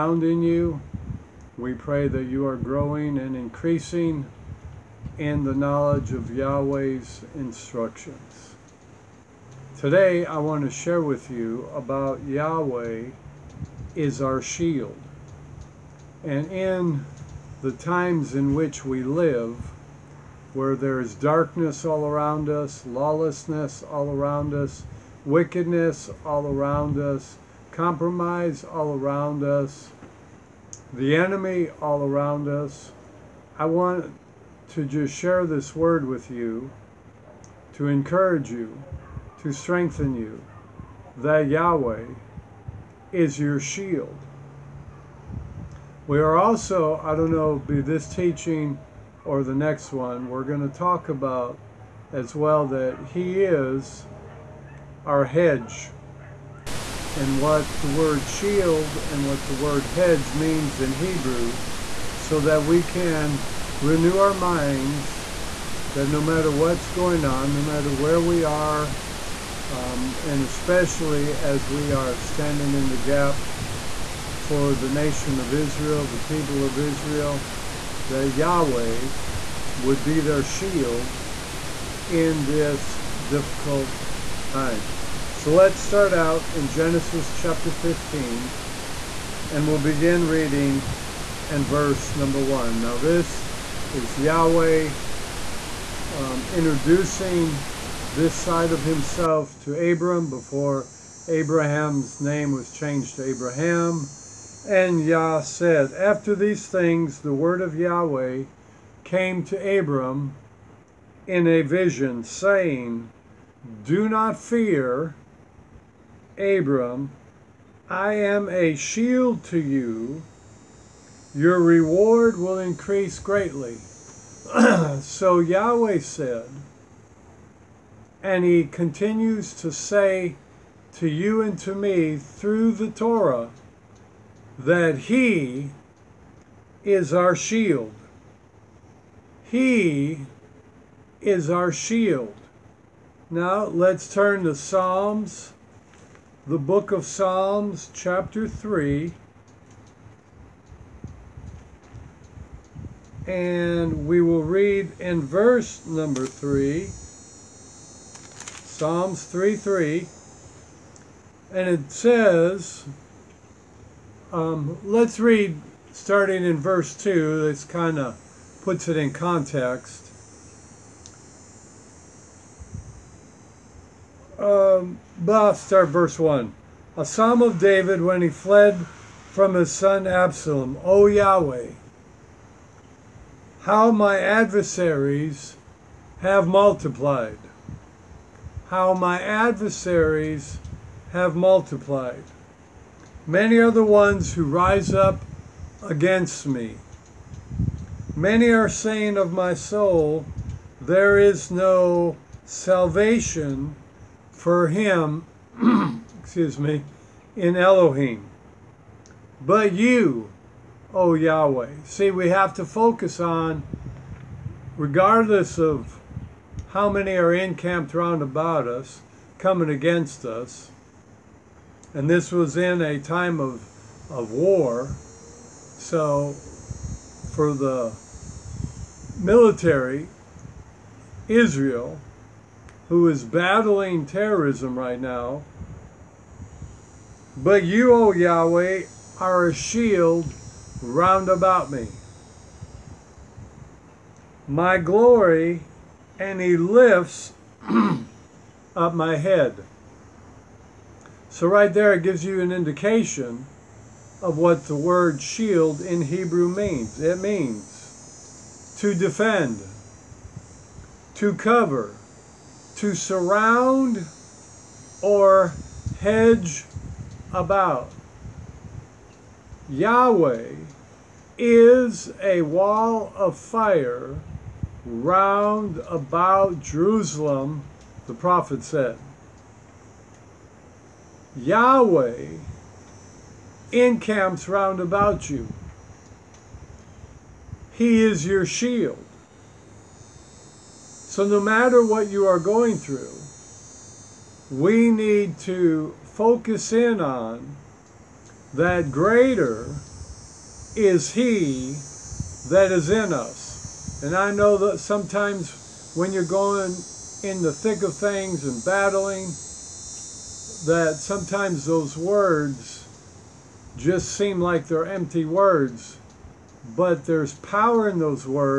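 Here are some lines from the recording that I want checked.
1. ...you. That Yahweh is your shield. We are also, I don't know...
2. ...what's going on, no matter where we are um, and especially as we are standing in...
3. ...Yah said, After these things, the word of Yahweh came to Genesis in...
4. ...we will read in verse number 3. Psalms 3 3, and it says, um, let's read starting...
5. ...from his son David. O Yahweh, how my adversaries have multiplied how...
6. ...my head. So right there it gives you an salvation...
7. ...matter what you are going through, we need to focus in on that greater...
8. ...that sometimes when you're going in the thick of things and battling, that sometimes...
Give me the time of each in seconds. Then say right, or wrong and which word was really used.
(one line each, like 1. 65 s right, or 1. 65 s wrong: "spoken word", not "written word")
1. 40 s right
2. 66 s right
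3. 105 s wrong: "Abram", not "Genesis"
4. 154 s right
5. 179 s wrong: "Absalom", not "David"
6. 248 s wrong: "indication", not "salvation"
7. 291 s right
8. 304 s right.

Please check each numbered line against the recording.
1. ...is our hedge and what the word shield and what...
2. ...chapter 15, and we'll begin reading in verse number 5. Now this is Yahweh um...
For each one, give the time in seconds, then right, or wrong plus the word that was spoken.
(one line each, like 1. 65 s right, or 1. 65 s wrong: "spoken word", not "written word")
1. 53 s right
2. 87 s wrong: "1", not "5".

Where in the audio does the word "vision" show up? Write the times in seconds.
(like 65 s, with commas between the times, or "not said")
111 s.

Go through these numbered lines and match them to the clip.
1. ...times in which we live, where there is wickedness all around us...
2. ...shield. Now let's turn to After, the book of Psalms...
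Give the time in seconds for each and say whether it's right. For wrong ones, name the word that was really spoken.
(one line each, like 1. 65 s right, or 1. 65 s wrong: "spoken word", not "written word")
1. 17 s wrong: "darkness", not "wickedness"
2. 141 s wrong: "Psalms", not "After".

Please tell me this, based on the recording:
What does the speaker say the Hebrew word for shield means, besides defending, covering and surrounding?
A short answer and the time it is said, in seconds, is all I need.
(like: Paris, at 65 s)
hedge about, at 266 s.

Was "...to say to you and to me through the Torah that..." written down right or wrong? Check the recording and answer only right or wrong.
right.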